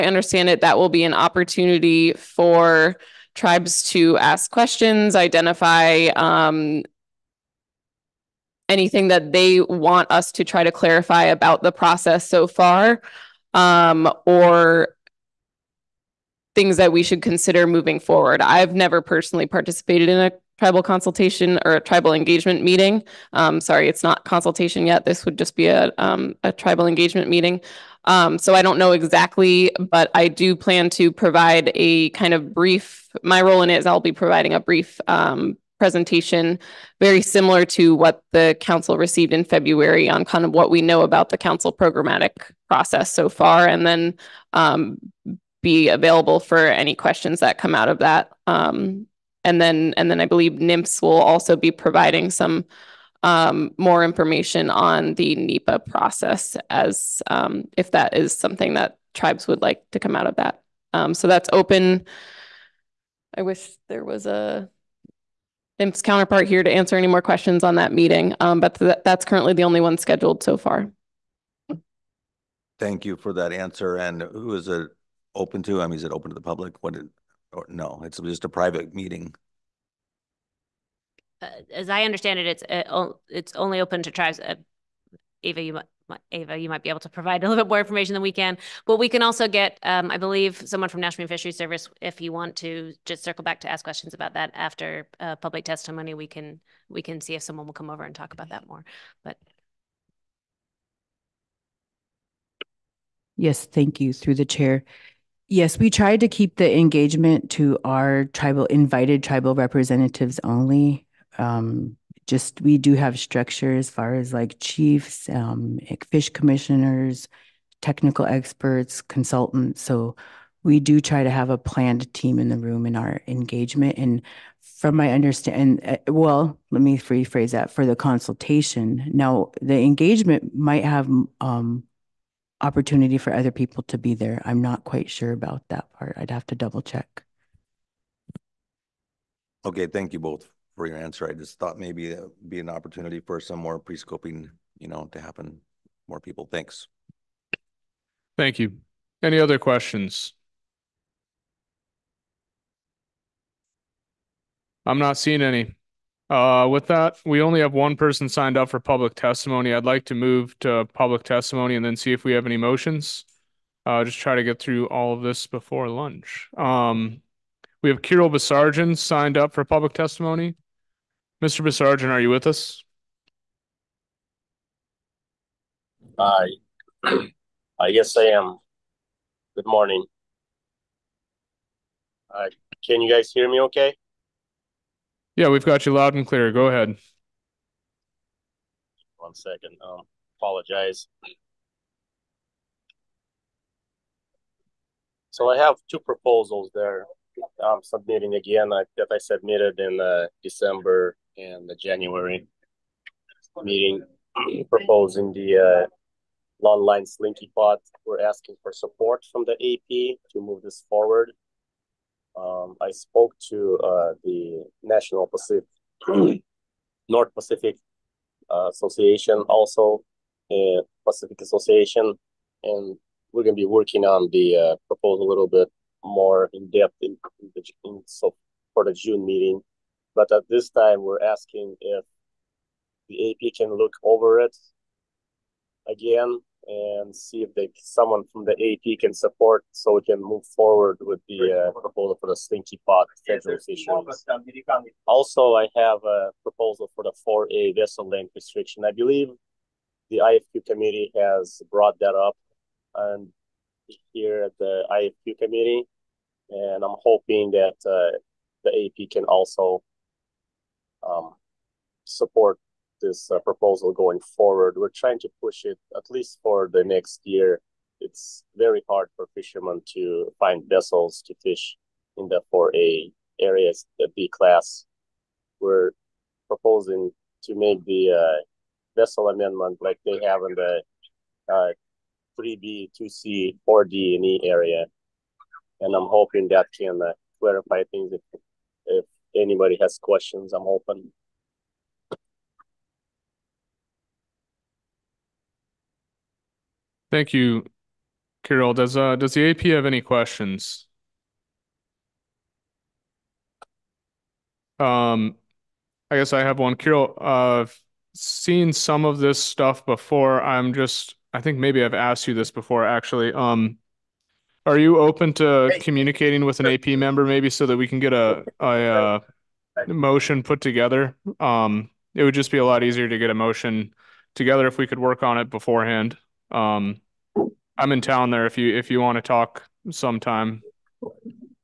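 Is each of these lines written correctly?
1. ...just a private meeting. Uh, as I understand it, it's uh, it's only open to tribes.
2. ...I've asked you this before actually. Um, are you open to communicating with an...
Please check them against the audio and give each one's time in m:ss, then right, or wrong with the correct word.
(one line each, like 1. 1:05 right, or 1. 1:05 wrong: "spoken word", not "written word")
1. 1:18 right
2. 5:11 right.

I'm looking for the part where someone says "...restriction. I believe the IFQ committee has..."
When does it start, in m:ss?
4:08.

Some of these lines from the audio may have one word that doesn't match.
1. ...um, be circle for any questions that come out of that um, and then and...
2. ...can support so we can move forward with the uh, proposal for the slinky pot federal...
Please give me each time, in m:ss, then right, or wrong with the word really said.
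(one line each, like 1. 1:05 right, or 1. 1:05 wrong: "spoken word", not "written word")
1. 0:44 wrong: "available", not "circle"
2. 3:58 right.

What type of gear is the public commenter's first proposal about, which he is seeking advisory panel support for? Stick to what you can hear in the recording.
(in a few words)
long line slinky pot.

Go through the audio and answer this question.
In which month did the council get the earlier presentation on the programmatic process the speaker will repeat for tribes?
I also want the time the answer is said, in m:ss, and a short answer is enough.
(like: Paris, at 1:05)
February, at 0:39.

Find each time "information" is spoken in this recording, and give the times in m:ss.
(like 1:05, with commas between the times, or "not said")
0:54, 1:27.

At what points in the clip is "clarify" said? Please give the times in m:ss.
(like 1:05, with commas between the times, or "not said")
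0:10, 4:47.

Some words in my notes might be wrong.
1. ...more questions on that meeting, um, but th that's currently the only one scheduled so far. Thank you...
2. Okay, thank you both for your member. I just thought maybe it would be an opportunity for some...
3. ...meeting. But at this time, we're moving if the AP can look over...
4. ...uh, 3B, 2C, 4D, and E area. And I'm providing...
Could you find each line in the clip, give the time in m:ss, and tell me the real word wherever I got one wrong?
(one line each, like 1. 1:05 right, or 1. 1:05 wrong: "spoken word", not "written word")
1. 1:07 right
2. 2:19 wrong: "answer", not "member"
3. 3:49 wrong: "asking", not "moving"
4. 4:41 wrong: "hoping", not "providing".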